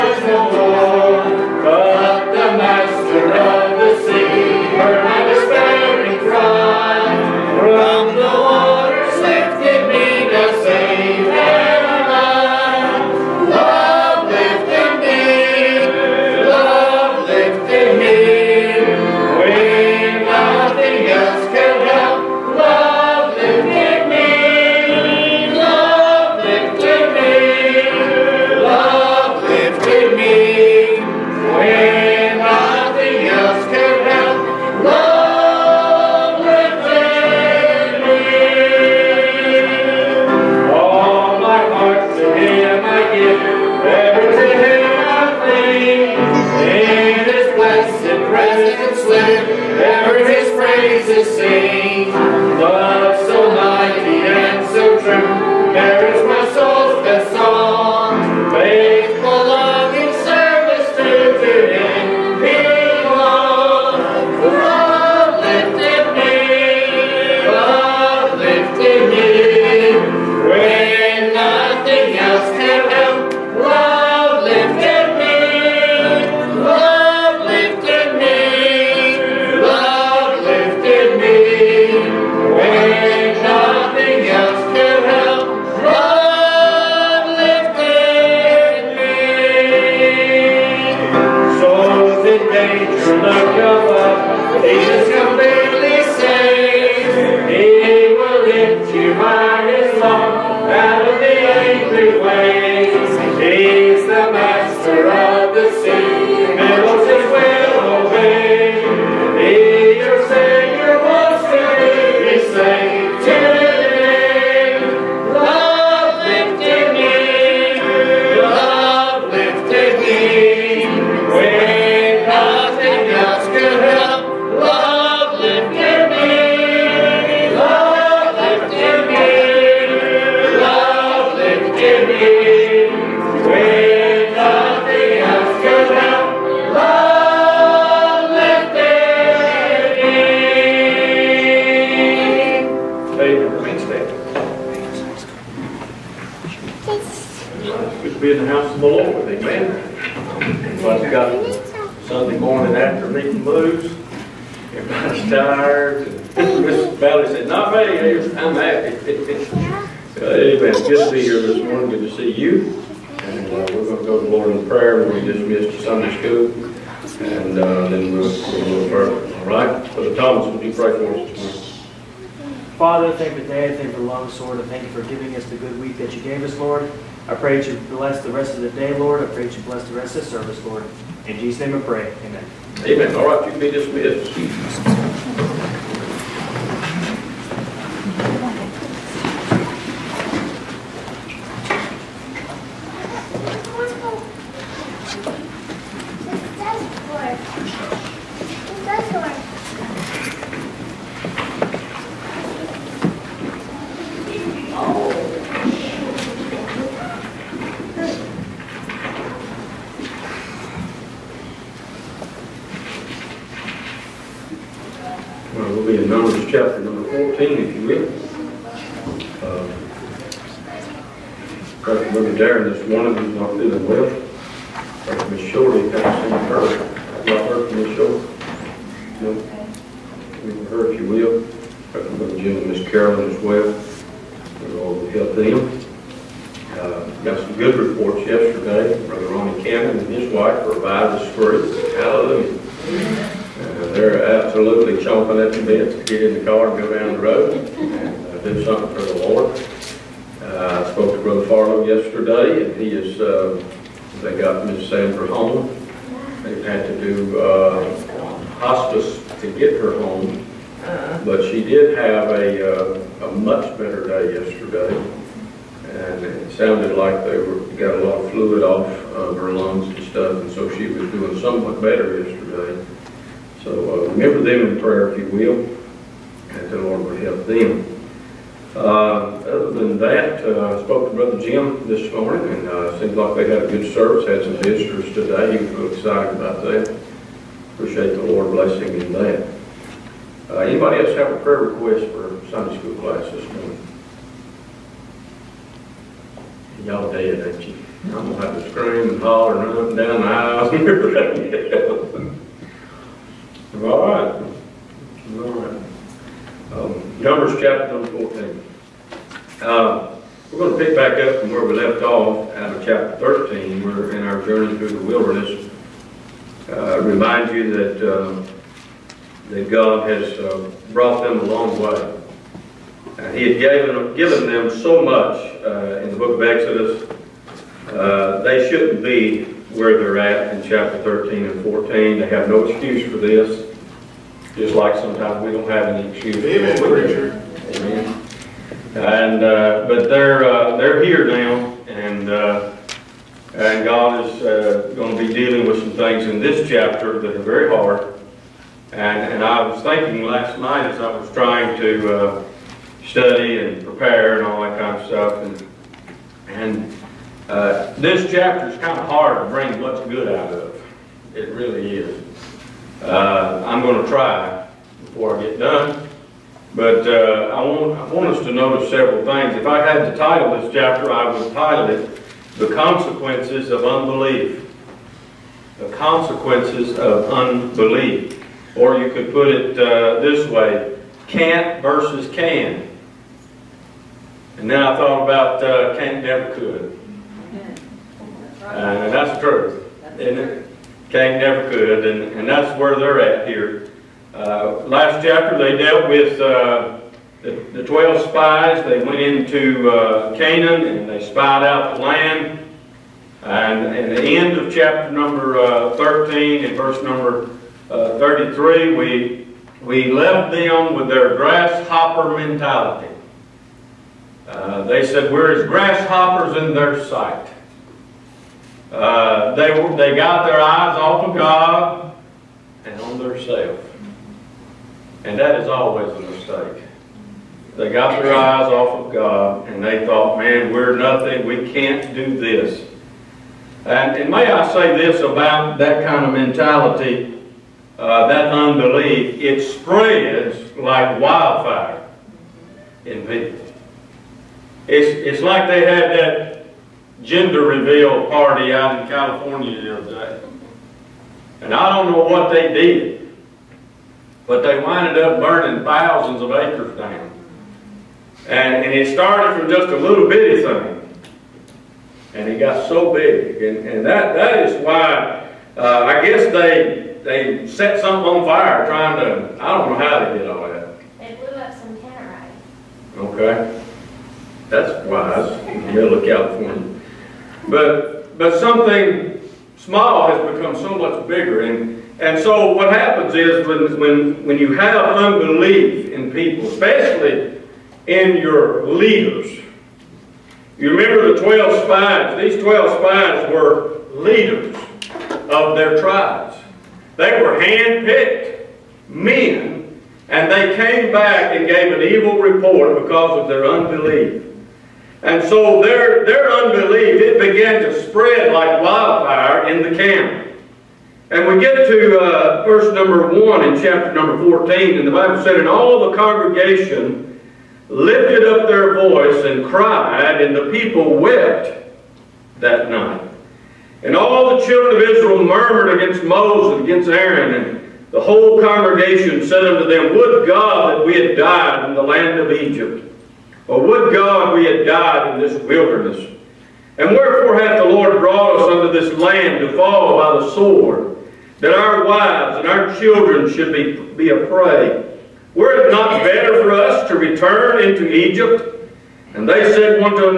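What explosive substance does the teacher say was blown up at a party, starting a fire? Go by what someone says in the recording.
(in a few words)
Tannerite.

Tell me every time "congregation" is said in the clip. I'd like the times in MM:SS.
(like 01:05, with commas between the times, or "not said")
08:36, 08:48.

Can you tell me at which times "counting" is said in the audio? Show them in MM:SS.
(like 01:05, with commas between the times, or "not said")
not said.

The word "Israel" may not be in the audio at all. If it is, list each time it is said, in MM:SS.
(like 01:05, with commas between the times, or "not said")
08:45.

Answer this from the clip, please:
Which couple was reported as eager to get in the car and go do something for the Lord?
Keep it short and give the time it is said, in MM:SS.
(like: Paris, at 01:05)
Brother Ronnie Cannon and his wife, at 03:59.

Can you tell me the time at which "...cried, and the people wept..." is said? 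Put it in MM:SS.
08:39.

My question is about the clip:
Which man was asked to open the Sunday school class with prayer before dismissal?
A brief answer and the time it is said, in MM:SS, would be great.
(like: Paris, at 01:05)
Brother Thomas, at 02:49.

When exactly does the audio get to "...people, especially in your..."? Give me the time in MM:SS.
08:06.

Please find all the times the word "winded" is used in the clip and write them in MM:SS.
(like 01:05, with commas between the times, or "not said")
07:34.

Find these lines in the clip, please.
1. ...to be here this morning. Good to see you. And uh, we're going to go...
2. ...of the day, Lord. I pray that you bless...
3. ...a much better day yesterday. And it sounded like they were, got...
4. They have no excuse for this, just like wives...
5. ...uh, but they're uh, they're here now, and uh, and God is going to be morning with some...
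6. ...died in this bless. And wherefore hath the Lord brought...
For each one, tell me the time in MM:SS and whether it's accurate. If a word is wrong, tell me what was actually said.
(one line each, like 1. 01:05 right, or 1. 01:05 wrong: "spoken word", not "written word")
1. 02:41 right
2. 02:58 right
3. 04:23 right
4. 05:32 wrong: "sometimes", not "wives"
5. 05:39 wrong: "dealing", not "morning"
6. 08:54 wrong: "wilderness", not "bless".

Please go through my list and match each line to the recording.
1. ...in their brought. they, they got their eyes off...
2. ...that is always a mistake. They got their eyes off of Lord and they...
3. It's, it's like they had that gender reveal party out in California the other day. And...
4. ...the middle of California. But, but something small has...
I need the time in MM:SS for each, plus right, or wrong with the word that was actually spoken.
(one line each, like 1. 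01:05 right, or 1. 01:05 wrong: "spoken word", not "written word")
1. 06:56 wrong: "sight", not "brought"
2. 07:05 wrong: "God", not "Lord"
3. 07:24 right
4. 07:55 right.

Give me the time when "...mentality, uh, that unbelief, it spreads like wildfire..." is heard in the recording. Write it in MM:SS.
07:16.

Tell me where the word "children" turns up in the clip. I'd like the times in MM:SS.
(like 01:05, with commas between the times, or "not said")
08:44, 09:02.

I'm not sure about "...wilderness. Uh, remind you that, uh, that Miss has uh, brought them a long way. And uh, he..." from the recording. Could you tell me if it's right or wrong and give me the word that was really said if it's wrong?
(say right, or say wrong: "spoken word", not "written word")
wrong: "God", not "Miss".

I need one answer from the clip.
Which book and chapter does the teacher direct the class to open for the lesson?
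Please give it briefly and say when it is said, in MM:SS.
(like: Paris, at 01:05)
Numbers 14, at 05:07.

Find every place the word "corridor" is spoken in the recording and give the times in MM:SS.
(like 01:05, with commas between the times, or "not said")
not said.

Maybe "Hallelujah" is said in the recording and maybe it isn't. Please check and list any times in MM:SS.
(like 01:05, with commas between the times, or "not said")
04:01.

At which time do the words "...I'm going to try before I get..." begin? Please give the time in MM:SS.
06:03.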